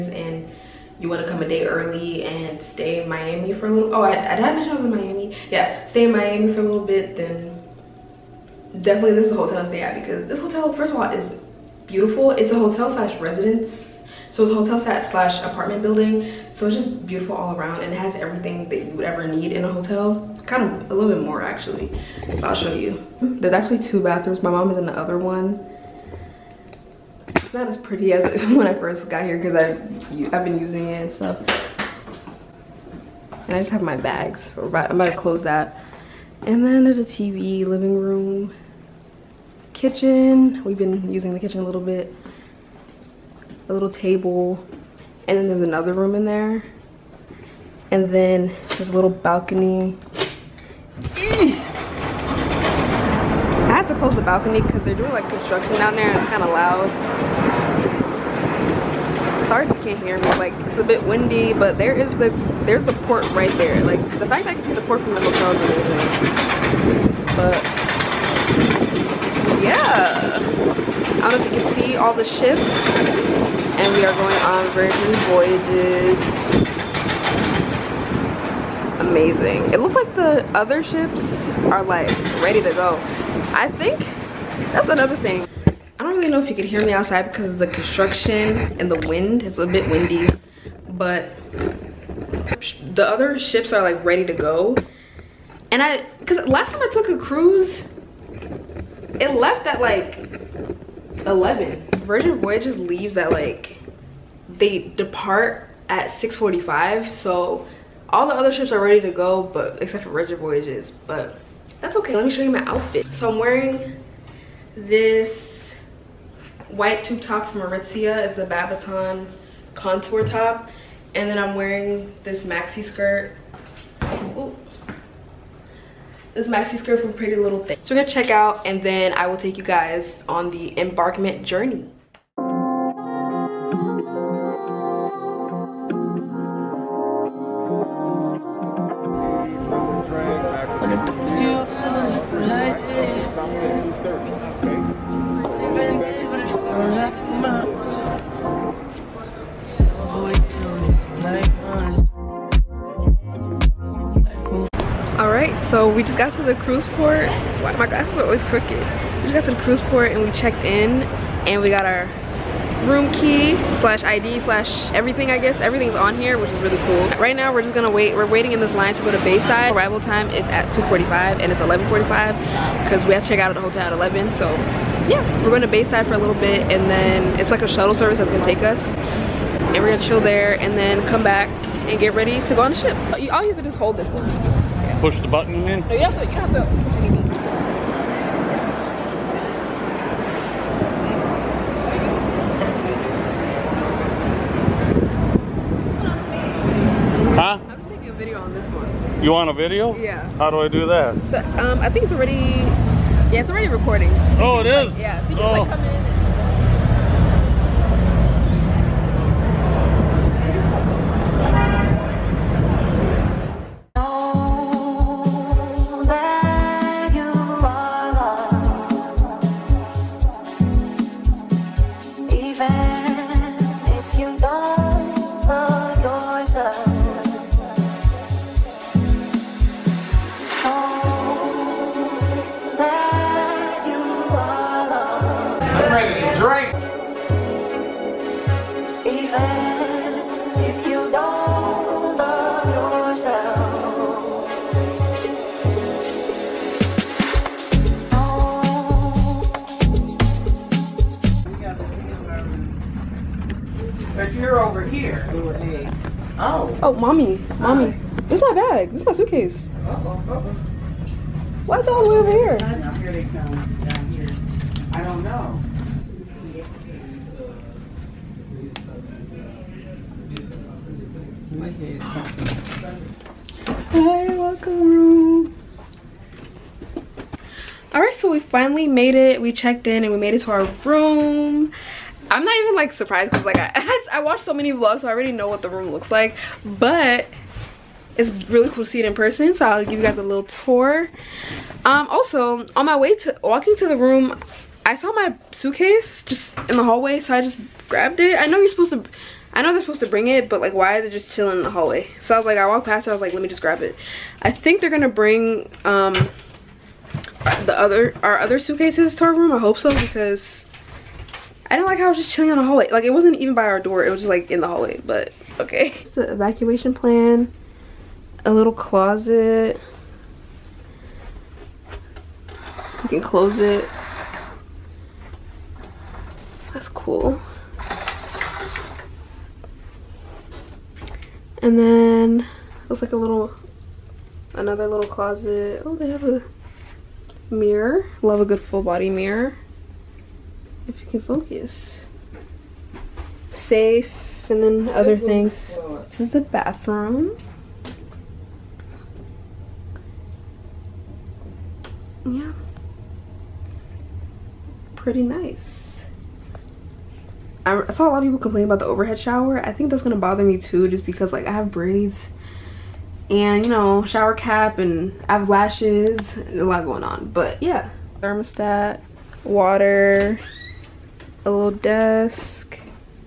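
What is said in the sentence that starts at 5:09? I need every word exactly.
I hope so because I didn't like how I was just chilling in the hallway.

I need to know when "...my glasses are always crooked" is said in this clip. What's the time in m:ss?
2:37.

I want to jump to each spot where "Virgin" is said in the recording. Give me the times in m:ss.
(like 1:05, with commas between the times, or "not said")
1:14, 1:42, 1:50.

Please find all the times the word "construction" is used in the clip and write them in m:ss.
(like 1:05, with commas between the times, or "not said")
0:55, 1:27.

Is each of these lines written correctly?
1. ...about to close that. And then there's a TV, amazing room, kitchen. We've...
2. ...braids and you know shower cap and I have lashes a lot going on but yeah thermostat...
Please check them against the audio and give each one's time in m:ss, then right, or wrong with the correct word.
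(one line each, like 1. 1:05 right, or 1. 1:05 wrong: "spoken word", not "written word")
1. 0:34 wrong: "living", not "amazing"
2. 6:01 right.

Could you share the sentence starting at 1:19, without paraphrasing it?
It looks like the other ships are like ready to go.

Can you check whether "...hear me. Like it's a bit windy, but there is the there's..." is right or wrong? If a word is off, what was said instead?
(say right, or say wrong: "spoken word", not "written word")
right.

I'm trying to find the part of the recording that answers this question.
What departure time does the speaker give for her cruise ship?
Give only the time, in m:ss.
1:46.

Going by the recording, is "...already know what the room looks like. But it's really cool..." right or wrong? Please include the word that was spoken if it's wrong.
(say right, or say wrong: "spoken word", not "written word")
right.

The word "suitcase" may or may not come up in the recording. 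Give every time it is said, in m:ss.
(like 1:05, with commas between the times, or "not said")
4:19, 4:55, 5:08.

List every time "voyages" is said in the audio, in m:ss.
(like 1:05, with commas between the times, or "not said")
1:15, 1:42, 1:50.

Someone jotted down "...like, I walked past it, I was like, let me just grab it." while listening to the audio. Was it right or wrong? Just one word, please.
right.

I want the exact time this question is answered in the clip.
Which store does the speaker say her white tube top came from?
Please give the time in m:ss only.
1:57.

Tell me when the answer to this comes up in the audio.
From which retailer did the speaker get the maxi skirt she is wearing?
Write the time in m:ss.
2:07.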